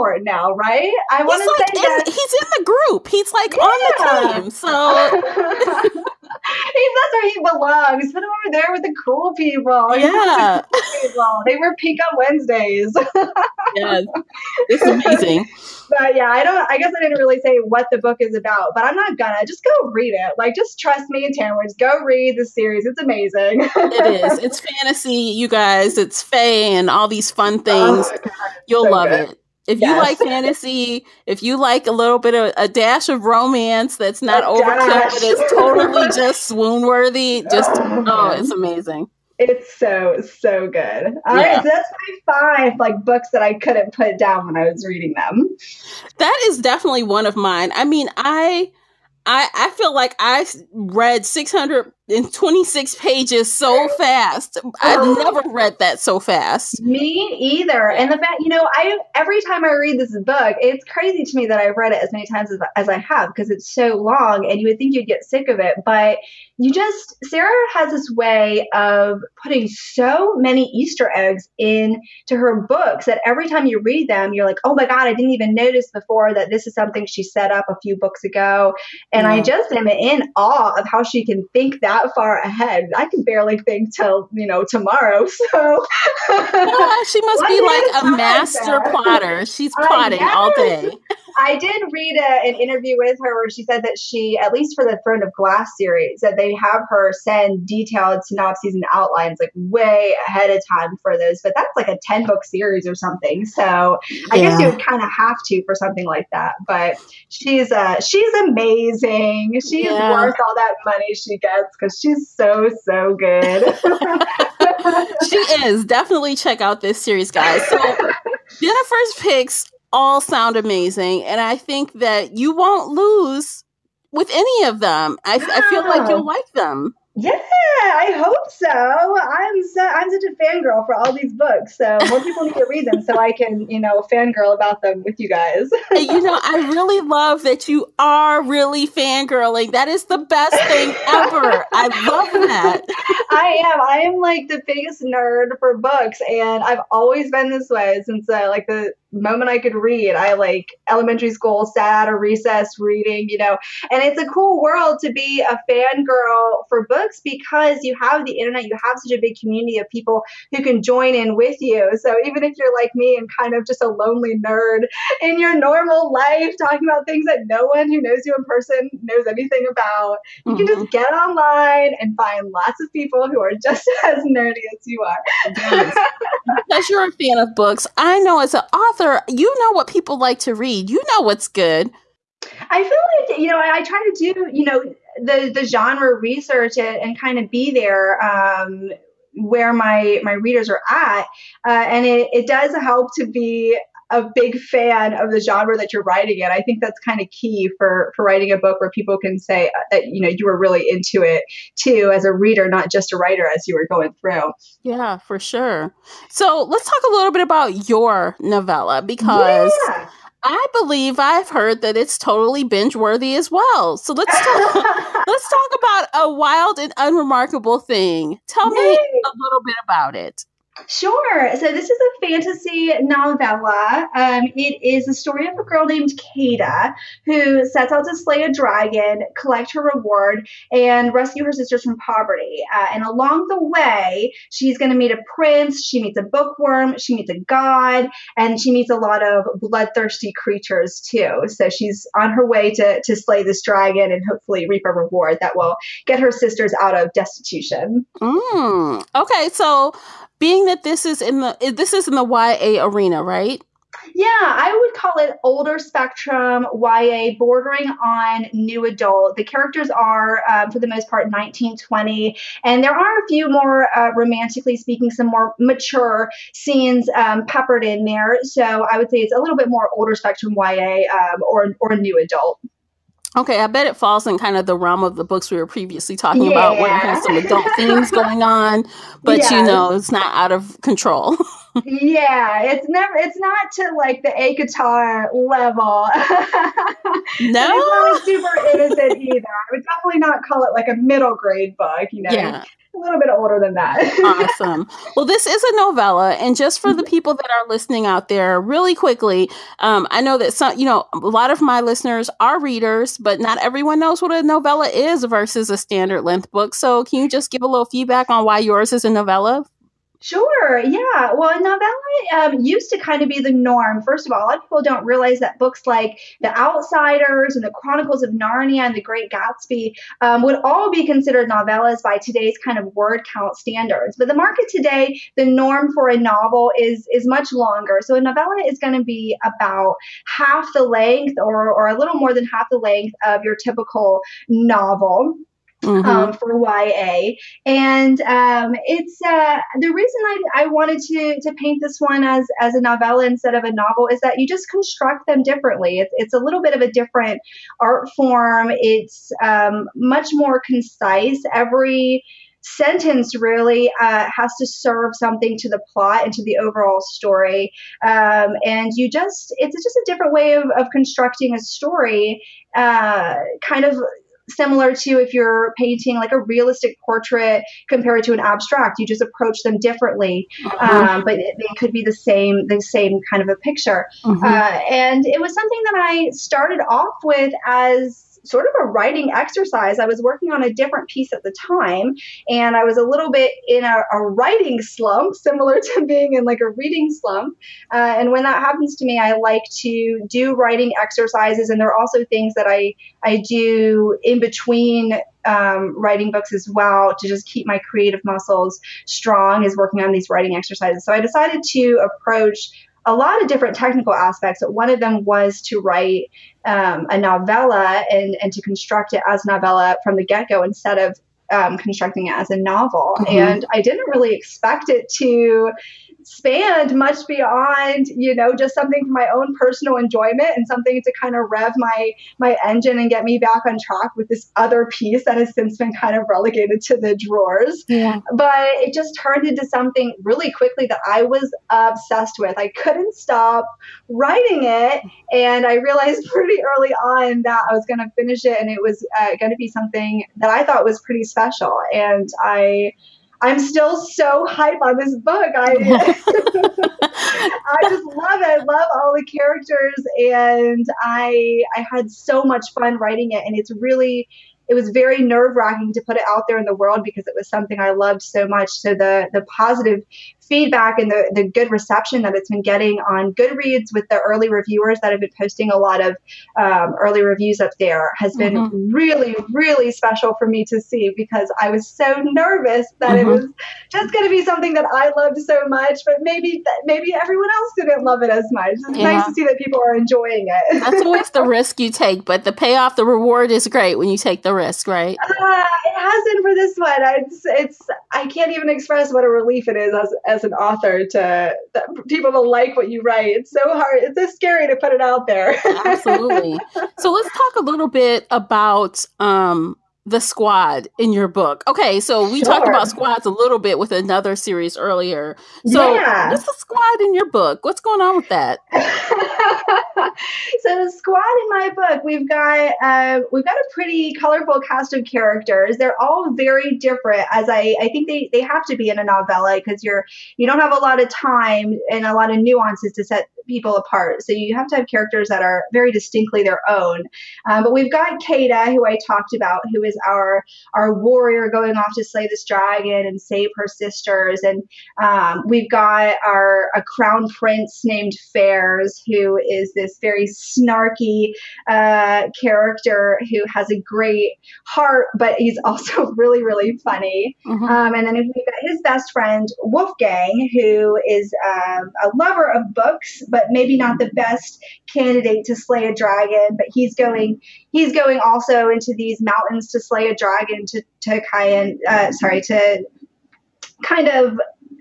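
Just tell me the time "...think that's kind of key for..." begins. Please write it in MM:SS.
03:16.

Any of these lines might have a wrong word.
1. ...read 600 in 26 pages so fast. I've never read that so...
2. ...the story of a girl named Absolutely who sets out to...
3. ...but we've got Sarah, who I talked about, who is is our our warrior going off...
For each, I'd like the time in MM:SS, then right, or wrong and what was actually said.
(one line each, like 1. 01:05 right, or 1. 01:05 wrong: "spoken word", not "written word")
1. 00:50 right
2. 03:45 wrong: "Kada", not "Absolutely"
3. 08:47 wrong: "Kada", not "Sarah".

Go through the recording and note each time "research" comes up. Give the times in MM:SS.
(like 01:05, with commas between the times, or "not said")
03:06.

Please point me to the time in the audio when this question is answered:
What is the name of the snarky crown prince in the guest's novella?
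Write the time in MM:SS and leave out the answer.
08:58.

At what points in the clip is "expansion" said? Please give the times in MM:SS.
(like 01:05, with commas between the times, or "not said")
not said.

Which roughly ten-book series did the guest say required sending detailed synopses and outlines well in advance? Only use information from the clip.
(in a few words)
Throne of Glass.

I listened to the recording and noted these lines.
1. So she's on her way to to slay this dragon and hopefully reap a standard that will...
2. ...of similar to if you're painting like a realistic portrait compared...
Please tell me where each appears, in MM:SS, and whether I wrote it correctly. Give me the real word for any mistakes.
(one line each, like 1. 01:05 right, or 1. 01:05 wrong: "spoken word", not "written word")
1. 04:01 wrong: "reward", not "standard"
2. 06:03 right.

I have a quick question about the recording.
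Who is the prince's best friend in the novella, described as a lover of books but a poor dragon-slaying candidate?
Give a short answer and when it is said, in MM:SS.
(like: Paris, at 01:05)
Wolfgang, at 09:09.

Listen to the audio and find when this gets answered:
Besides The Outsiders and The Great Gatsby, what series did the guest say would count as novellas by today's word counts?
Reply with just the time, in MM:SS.
05:17.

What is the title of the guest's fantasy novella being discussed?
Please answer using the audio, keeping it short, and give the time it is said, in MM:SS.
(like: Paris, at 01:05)
A Wild and Unremarkable Thing, at 03:36.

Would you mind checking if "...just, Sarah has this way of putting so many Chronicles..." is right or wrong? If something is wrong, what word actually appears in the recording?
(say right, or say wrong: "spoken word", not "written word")
wrong: "Easter", not "Chronicles".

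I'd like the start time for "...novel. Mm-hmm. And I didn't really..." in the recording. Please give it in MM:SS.
06:52.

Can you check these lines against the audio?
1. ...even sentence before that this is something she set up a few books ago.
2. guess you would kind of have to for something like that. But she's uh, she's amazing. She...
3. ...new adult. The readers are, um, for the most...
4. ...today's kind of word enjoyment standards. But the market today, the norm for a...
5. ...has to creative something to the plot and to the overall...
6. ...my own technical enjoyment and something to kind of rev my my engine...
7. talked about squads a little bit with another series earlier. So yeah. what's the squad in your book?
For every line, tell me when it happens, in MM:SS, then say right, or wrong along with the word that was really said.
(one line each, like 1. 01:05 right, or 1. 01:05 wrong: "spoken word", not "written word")
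1. 01:15 wrong: "notice", not "sentence"
2. 01:44 right
3. 04:18 wrong: "characters", not "readers"
4. 05:22 wrong: "count", not "enjoyment"
5. 05:54 wrong: "serve", not "creative"
6. 06:59 wrong: "personal", not "technical"
7. 08:22 right.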